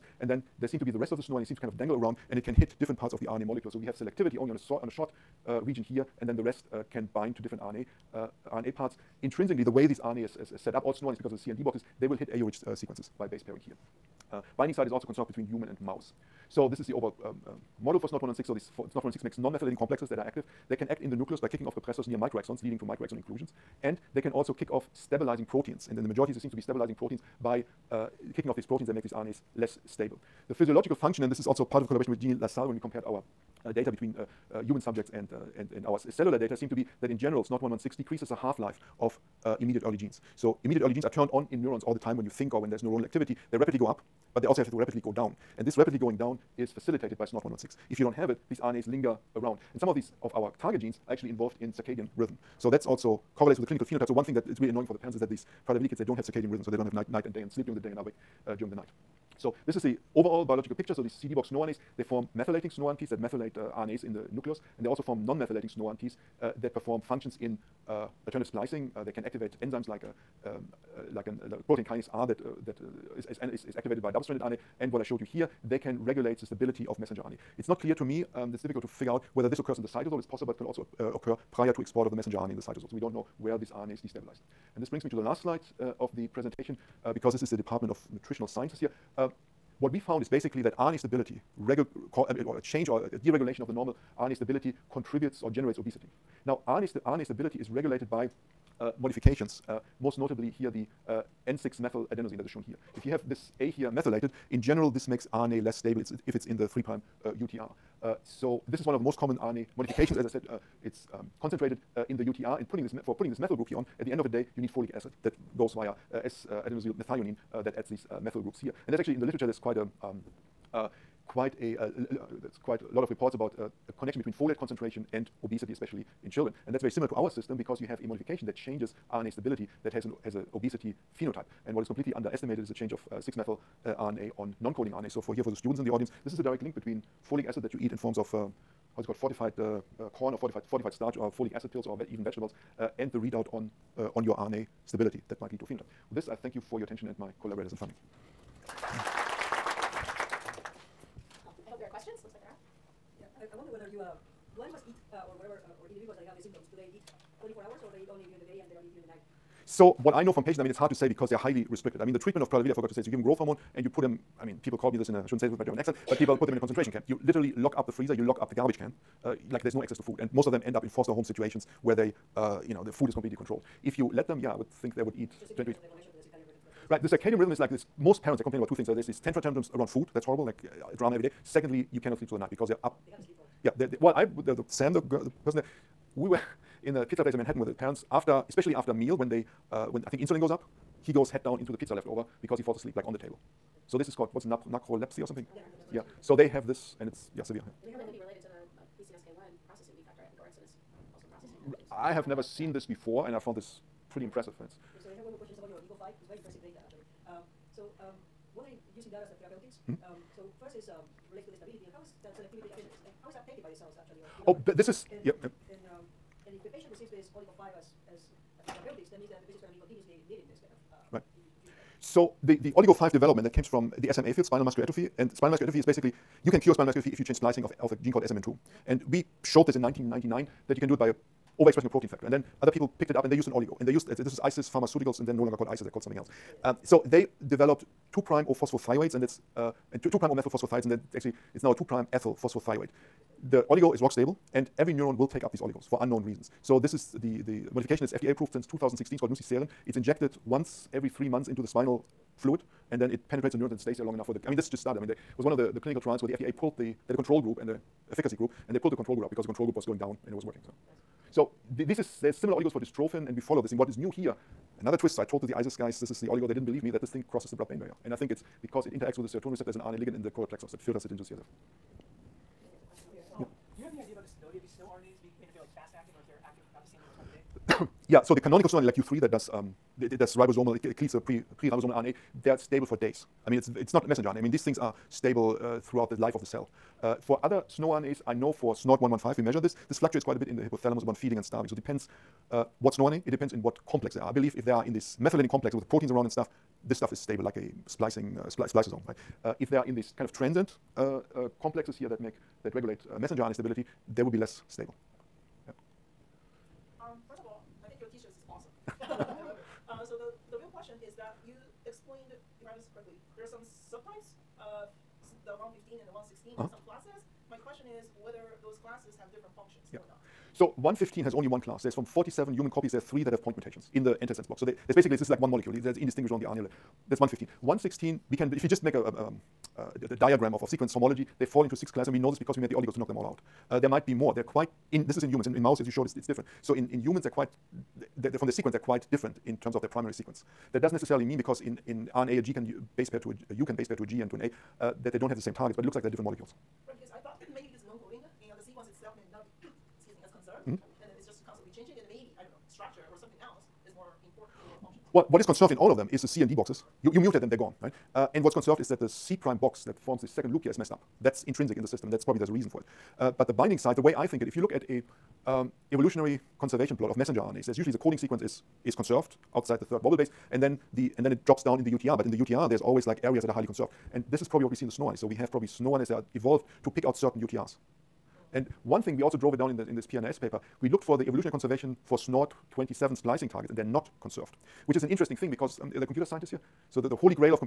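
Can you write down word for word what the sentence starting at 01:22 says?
So we don't know where this RNA is destabilized.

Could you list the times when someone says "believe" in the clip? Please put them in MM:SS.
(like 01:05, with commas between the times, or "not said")
04:26, 04:54.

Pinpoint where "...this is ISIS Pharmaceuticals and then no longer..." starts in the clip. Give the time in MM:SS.
03:54.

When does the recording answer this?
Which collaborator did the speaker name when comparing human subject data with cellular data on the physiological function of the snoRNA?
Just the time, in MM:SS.
00:32.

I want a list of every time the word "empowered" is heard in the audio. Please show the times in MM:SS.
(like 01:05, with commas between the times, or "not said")
not said.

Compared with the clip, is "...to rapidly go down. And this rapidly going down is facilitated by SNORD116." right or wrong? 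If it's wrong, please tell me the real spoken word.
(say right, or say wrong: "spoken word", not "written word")
right.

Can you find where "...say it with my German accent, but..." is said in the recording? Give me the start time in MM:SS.
02:45.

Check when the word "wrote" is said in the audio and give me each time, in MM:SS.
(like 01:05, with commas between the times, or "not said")
not said.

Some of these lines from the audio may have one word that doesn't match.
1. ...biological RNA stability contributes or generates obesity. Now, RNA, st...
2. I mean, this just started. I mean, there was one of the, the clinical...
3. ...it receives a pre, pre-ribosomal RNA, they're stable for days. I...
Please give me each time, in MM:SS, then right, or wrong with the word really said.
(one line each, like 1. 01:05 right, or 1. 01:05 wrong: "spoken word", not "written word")
1. 01:33 wrong: "normal", not "biological"
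2. 04:14 right
3. 04:40 wrong: "cleaves", not "receives".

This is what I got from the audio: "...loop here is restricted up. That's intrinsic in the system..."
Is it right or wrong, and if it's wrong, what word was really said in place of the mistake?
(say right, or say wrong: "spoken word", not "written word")
wrong: "messed", not "restricted".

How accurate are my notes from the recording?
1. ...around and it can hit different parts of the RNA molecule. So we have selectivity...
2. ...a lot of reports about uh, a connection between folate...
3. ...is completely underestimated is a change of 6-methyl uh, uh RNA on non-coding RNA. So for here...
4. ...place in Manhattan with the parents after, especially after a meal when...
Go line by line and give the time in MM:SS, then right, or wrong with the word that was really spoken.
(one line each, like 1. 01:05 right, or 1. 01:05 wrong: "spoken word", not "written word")
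1. 00:01 right
2. 02:02 right
3. 02:11 right
4. 03:07 right.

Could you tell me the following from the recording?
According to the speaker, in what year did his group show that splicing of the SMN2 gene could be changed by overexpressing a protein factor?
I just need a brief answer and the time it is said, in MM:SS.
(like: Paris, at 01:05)
1999, at 03:49.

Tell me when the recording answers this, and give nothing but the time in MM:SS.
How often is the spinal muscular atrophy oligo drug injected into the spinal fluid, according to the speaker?
04:10.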